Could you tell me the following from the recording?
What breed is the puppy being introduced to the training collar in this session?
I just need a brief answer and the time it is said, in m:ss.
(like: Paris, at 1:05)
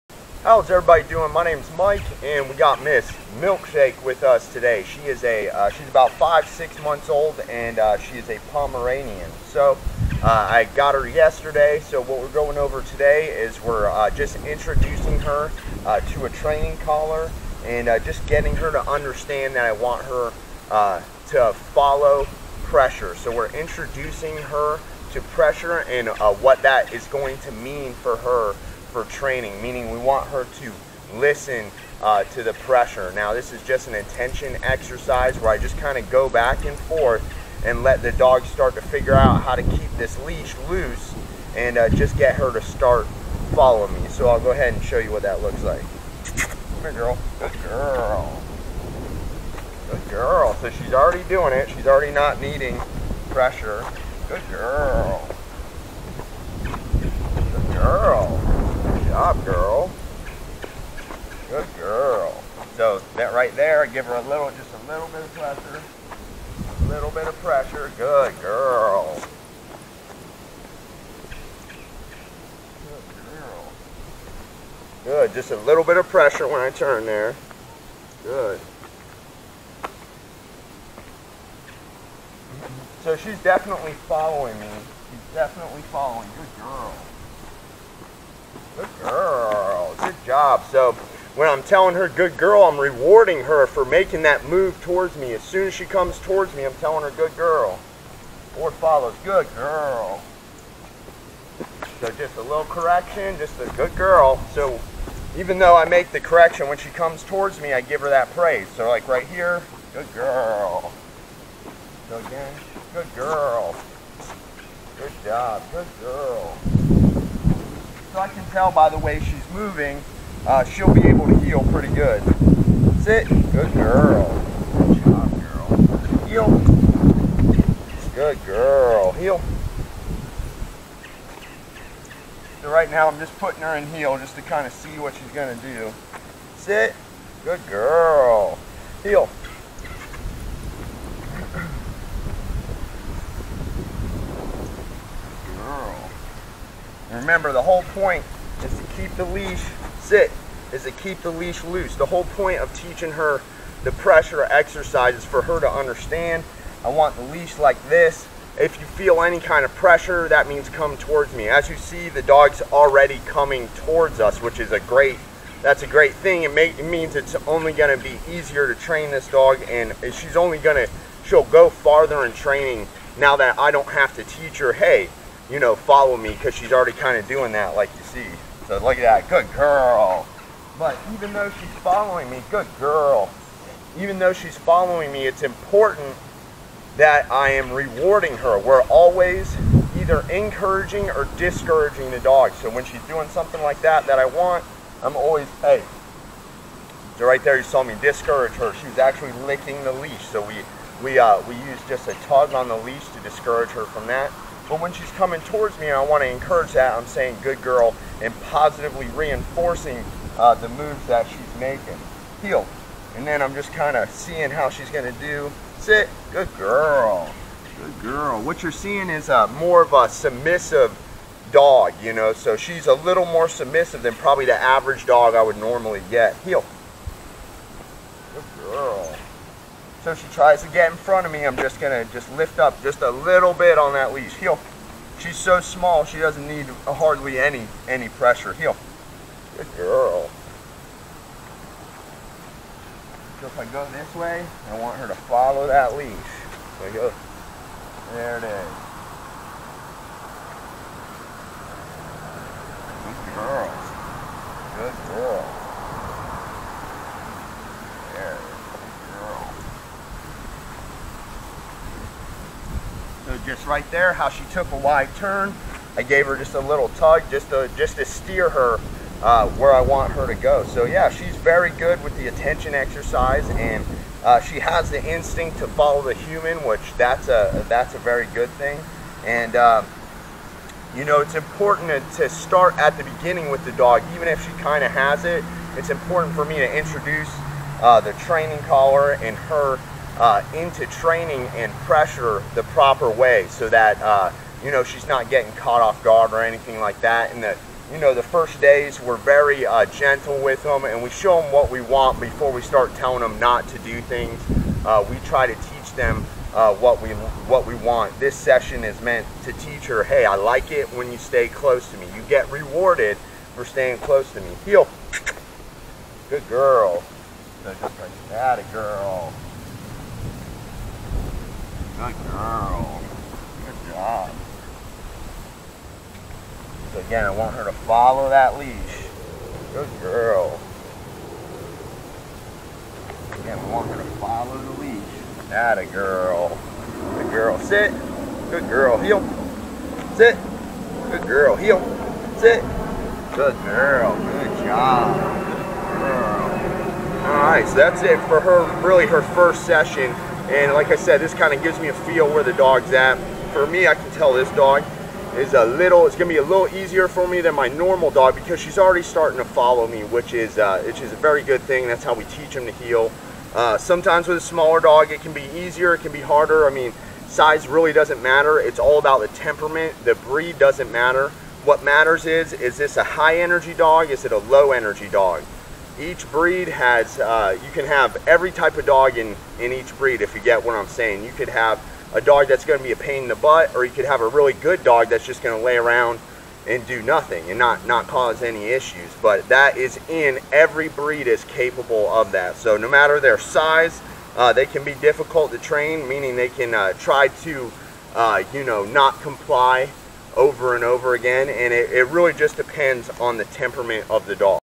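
Pomeranian, at 0:08.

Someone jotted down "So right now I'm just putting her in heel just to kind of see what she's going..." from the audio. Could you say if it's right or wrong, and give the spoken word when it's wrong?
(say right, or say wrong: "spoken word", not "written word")
right.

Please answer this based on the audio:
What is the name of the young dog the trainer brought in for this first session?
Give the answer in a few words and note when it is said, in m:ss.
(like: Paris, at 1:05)
Milkshake, at 0:02.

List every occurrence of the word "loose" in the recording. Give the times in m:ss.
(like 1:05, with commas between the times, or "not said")
0:40, 2:31.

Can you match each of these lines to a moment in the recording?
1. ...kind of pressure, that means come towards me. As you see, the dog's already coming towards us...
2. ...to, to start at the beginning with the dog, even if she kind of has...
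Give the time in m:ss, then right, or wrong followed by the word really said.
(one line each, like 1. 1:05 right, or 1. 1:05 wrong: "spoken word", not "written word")
1. 2:39 right
2. 4:41 right.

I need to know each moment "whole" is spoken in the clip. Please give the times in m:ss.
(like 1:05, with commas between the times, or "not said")
2:27, 2:32.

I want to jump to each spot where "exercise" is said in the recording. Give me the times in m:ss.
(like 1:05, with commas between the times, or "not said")
0:34, 2:34, 4:32.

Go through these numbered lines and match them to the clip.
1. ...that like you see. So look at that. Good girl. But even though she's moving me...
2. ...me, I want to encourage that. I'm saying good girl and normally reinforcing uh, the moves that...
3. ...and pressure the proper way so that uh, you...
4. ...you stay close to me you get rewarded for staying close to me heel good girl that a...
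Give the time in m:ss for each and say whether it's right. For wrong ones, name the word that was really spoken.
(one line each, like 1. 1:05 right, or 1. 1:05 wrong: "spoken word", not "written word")
1. 2:57 wrong: "following", not "moving"
2. 3:25 wrong: "positively", not "normally"
3. 4:51 right
4. 5:11 right.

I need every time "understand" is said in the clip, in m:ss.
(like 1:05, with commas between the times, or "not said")
0:18, 2:35.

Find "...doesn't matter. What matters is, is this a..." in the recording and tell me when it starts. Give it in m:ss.
6:10.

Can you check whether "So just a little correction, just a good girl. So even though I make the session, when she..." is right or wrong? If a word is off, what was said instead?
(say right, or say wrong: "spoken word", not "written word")
wrong: "correction", not "session".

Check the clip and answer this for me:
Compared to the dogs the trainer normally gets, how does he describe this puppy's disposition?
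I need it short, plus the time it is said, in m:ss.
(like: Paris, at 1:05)
More submissive, at 3:43.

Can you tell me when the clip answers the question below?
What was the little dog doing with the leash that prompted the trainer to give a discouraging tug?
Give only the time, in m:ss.
3:19.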